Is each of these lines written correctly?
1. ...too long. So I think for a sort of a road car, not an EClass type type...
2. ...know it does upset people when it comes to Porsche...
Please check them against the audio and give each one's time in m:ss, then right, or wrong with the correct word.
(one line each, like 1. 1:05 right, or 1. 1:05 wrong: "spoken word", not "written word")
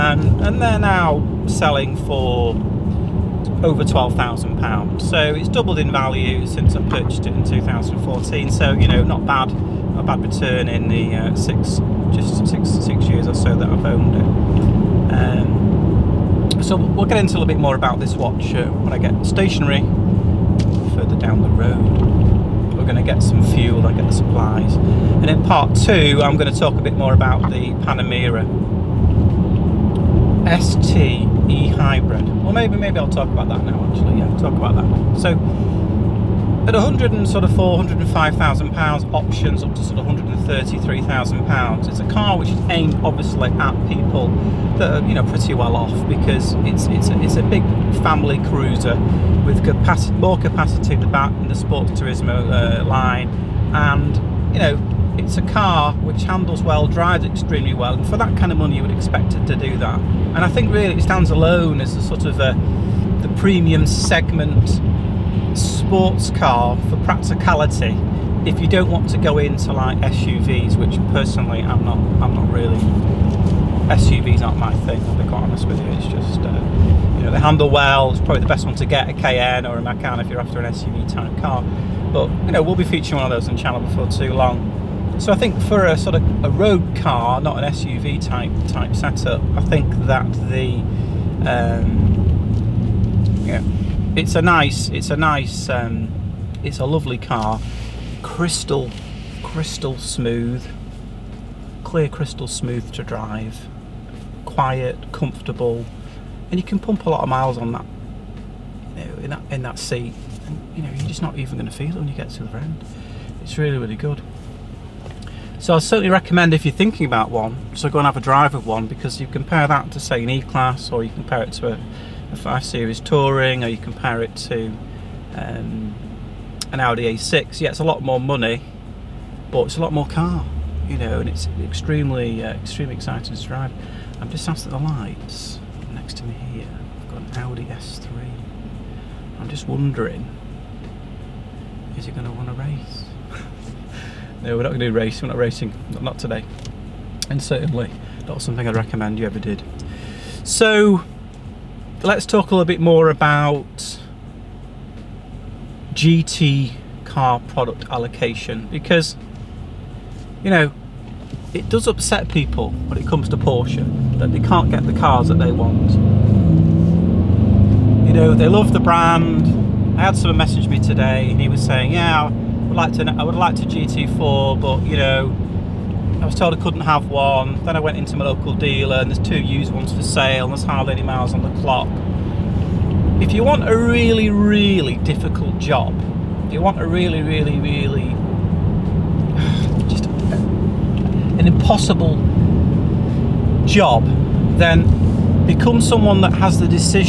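1. 1:24 wrong: "SUV", not "EClass"
2. 2:40 right.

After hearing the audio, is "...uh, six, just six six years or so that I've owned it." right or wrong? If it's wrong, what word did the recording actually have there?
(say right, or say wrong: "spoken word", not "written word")
right.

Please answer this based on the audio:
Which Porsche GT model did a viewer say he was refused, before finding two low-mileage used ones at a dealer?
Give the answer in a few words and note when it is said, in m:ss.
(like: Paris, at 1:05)
GT4, at 2:53.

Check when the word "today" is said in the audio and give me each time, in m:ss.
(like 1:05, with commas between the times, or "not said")
2:26, 2:50.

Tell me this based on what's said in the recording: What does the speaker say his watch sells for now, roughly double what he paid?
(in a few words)
Over £12,000.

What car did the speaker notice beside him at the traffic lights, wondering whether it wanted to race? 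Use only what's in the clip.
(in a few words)
Audi S3.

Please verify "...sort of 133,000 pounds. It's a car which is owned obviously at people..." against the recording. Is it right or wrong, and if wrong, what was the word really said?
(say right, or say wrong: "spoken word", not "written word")
wrong: "aimed", not "owned".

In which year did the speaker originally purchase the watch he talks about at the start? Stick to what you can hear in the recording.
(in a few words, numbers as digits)
2014.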